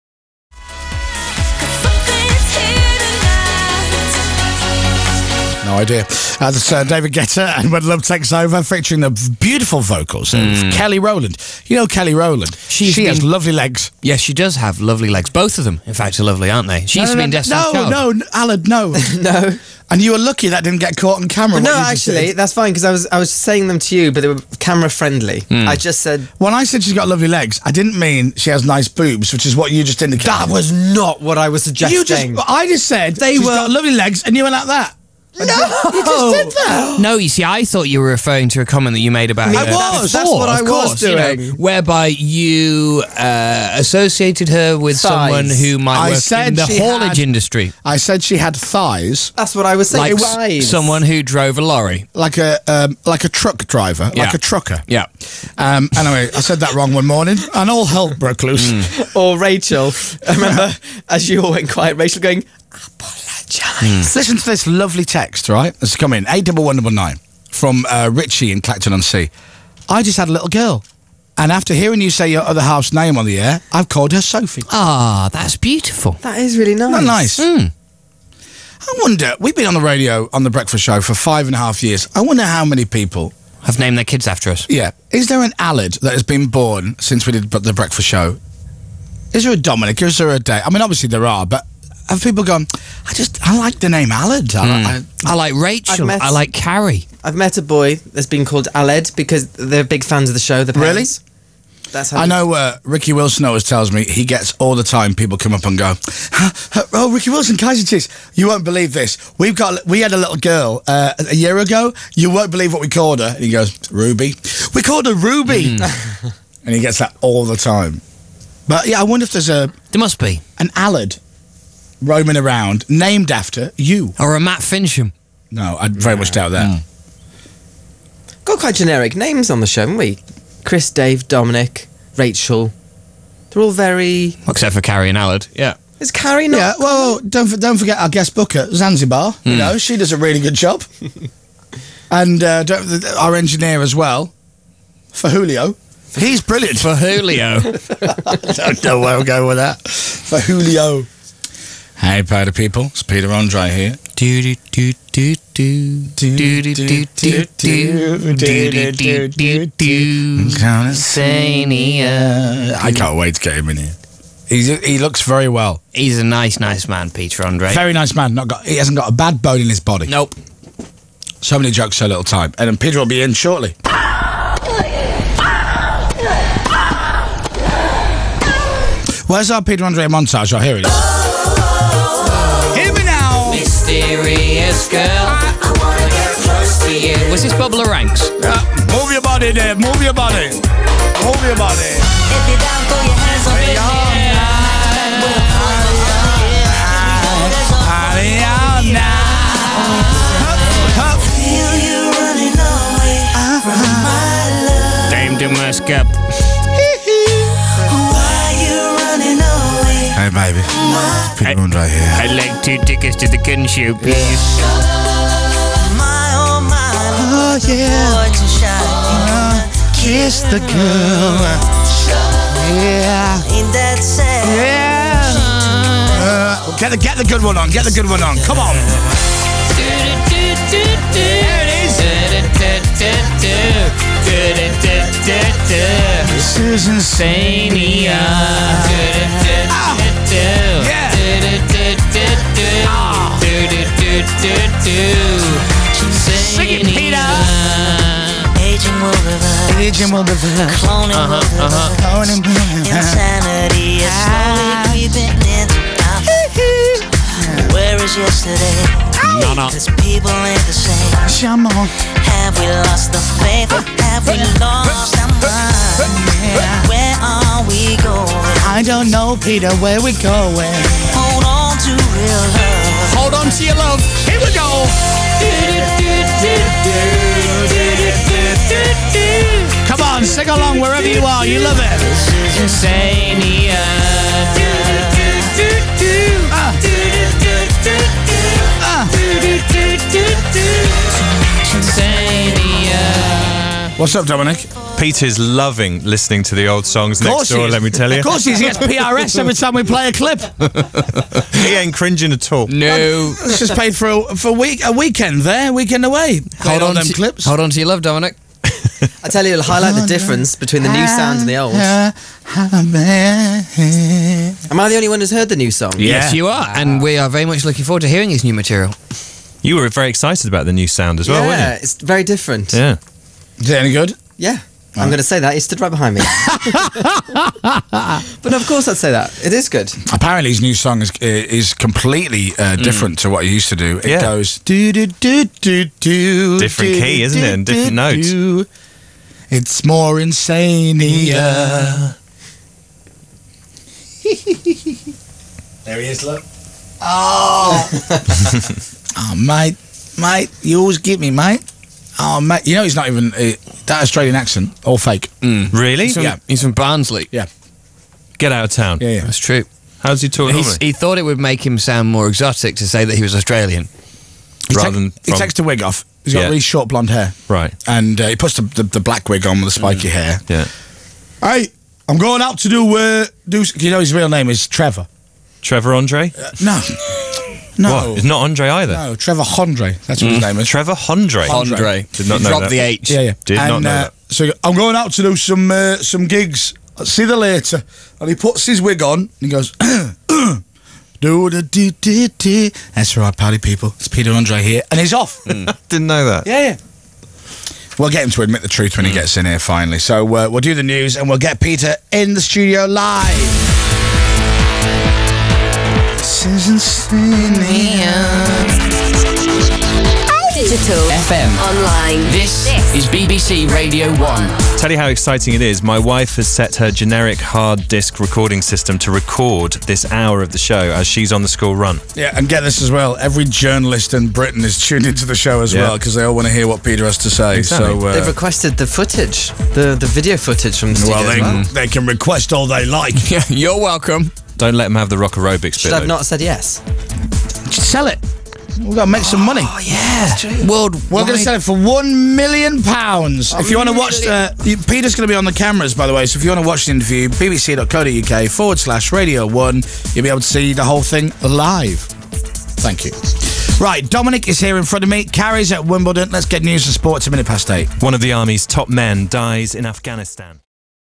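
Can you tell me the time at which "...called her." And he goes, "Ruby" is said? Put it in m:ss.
1:52.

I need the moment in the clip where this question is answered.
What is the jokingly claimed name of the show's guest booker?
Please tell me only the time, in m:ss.
2:18.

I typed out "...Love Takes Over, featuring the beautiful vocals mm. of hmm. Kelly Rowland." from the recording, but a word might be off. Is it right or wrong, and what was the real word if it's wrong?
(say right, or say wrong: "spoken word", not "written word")
right.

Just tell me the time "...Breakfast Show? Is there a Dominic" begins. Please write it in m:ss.
1:27.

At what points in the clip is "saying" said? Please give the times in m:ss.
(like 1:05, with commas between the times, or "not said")
0:23, 0:49.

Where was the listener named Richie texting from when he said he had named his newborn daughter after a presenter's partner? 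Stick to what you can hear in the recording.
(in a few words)
Clacton-on-Sea.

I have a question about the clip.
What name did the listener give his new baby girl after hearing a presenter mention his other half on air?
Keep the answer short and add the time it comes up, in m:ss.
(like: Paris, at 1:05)
Sophie, at 1:14.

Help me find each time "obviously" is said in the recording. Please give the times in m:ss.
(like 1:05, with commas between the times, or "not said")
1:30.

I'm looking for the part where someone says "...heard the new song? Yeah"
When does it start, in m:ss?
5:15.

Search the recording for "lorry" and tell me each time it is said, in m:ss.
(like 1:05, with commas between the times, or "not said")
0:51.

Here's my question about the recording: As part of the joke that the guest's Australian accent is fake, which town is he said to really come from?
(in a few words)
Barnsley.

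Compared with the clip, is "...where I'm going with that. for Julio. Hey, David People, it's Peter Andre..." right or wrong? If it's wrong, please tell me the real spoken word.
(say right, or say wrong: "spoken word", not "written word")
wrong: "Party", not "David".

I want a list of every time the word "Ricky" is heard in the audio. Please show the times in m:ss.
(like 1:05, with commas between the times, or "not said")
1:42, 1:47.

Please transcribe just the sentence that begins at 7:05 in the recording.
well because they all want to hear what Peter has to say.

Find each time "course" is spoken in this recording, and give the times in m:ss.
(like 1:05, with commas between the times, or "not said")
0:40, 4:58, 5:28.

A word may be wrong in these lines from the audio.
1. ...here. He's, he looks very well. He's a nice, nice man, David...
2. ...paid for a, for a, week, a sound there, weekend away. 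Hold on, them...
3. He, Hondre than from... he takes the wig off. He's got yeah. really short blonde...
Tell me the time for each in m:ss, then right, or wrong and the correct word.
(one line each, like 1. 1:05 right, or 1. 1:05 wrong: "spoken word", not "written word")
1. 2:43 wrong: "Peter", not "David"
2. 5:03 wrong: "weekend", not "sound"
3. 6:04 wrong: "Rather", not "Hondre".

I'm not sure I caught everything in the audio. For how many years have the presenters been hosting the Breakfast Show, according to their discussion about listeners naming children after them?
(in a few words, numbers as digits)
Five and a half.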